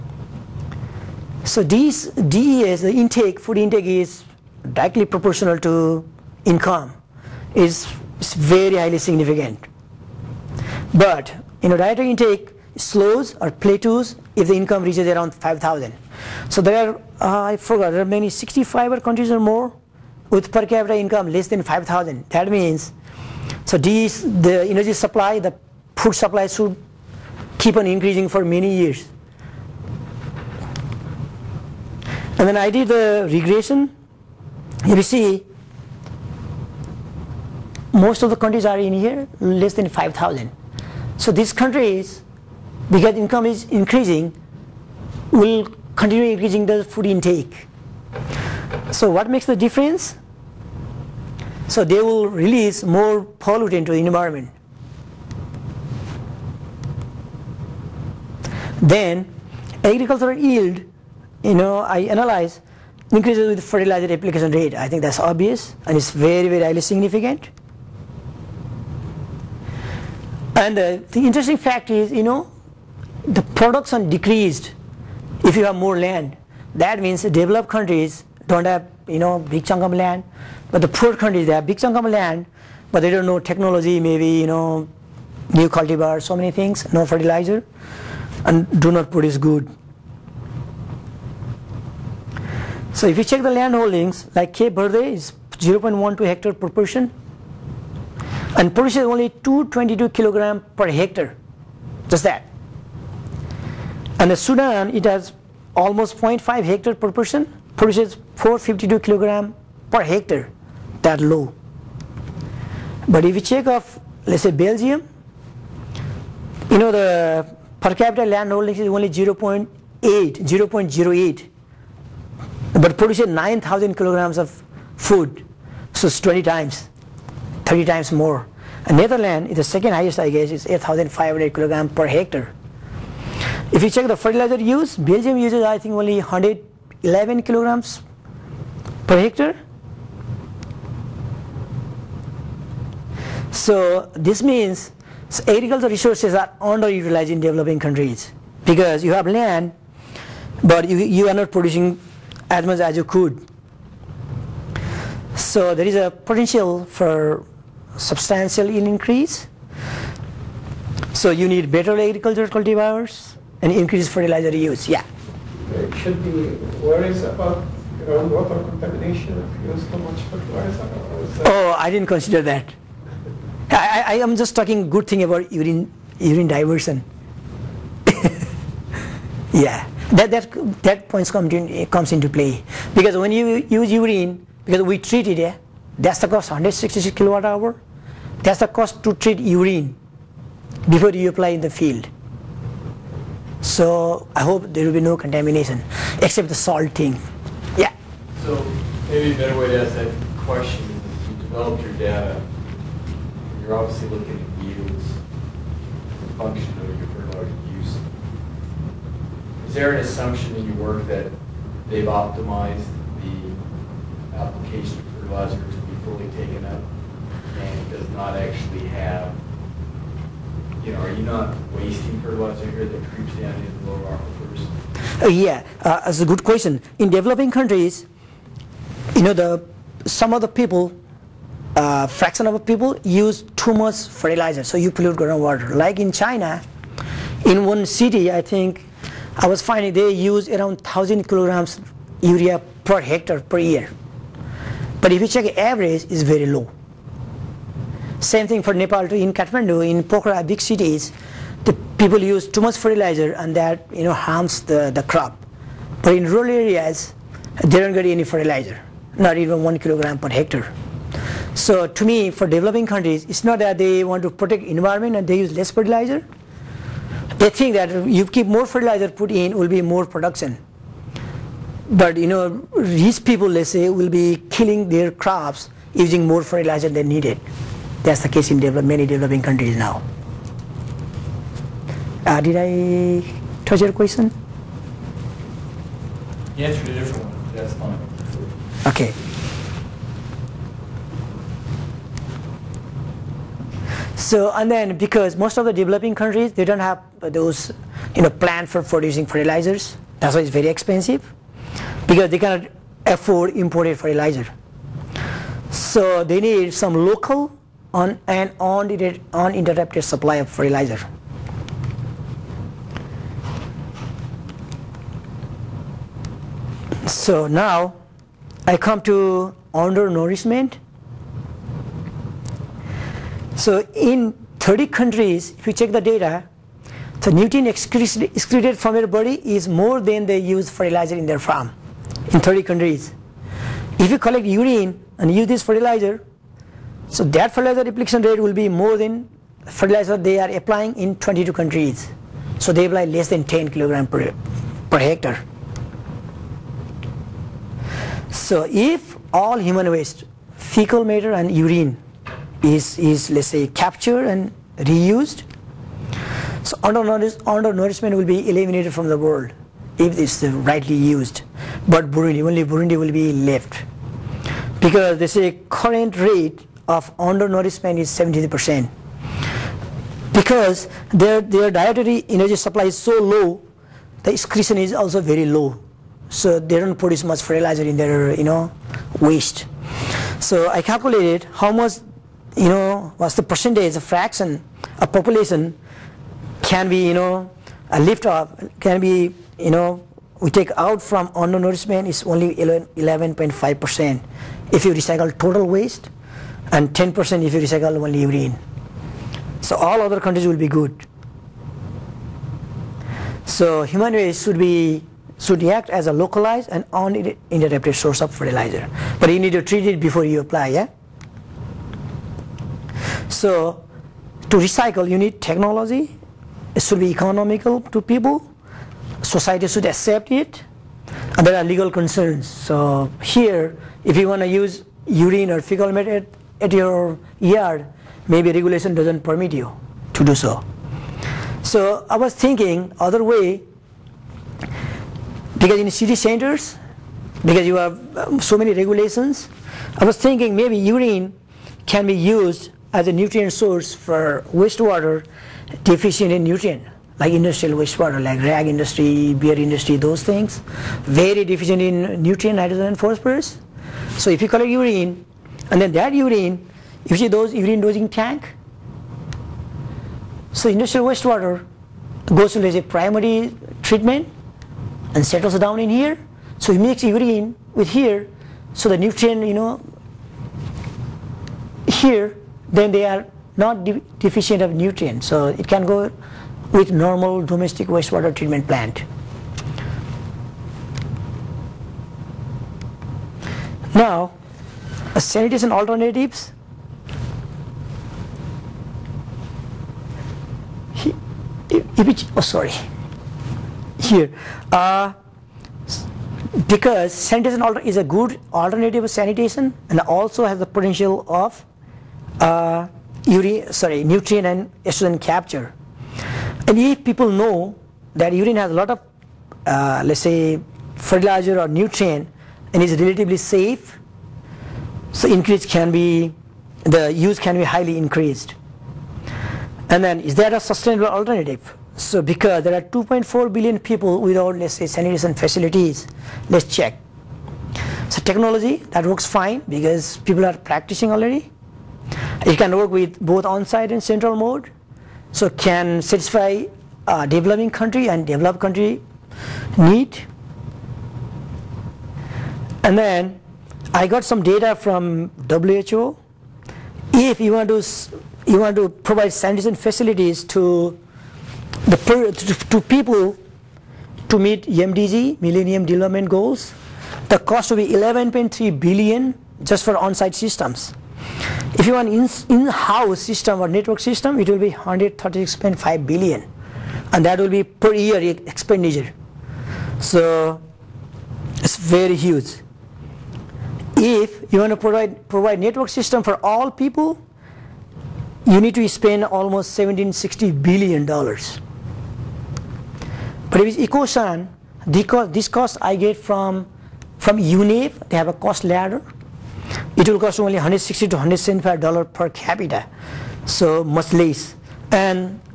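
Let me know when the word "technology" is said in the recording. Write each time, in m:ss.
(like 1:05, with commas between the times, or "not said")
1:23, 6:55, 8:48.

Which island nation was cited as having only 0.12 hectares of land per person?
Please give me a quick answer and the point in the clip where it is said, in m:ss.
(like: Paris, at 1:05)
Cape Verde, at 1:34.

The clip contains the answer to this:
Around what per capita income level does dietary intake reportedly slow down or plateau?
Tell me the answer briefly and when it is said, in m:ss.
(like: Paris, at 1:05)
5,000, at 0:15.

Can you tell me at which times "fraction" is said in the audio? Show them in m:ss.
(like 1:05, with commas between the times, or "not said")
3:52, 6:23.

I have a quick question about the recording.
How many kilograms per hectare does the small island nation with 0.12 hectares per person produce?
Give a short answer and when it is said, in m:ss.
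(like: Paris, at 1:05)
222, at 1:39.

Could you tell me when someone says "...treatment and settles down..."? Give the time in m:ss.
7:43.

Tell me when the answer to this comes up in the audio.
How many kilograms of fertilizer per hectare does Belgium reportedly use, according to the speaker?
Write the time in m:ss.
2:16.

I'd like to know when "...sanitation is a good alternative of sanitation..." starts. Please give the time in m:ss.
8:17.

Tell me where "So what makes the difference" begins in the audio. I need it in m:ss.
0:48.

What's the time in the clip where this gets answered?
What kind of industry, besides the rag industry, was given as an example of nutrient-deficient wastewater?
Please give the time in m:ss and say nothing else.
7:29.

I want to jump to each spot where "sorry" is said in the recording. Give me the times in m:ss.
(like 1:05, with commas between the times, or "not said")
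8:12, 8:23.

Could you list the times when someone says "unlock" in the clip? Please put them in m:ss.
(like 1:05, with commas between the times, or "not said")
not said.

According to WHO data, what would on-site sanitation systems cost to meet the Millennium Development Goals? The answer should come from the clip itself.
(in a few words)
11.3 billion.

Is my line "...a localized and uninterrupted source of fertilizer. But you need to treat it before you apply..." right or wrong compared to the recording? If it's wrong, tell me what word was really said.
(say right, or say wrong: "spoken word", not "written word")
right.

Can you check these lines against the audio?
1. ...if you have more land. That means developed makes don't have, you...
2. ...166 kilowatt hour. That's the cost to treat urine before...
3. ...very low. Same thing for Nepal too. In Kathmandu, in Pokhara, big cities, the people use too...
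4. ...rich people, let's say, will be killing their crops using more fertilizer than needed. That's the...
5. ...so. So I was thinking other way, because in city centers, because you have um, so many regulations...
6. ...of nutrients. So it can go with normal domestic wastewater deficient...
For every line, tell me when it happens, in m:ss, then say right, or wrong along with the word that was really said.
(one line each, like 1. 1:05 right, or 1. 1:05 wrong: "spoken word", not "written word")
1. 1:15 wrong: "countries", not "makes"
2. 3:06 right
3. 4:06 right
4. 4:32 right
5. 7:10 right
6. 7:54 wrong: "treatment", not "deficient".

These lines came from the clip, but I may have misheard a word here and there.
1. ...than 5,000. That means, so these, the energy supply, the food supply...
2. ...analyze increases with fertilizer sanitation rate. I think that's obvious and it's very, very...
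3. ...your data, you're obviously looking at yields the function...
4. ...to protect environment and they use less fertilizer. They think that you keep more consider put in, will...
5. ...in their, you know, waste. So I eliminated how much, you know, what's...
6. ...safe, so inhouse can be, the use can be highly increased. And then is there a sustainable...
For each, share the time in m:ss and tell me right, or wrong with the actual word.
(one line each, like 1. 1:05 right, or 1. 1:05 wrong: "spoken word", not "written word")
1. 0:21 right
2. 1:01 wrong: "application", not "sanitation"
3. 3:21 right
4. 4:24 wrong: "fertilizer", not "consider"
5. 6:17 wrong: "calculated", not "eliminated"
6. 8:33 wrong: "increase", not "inhouse".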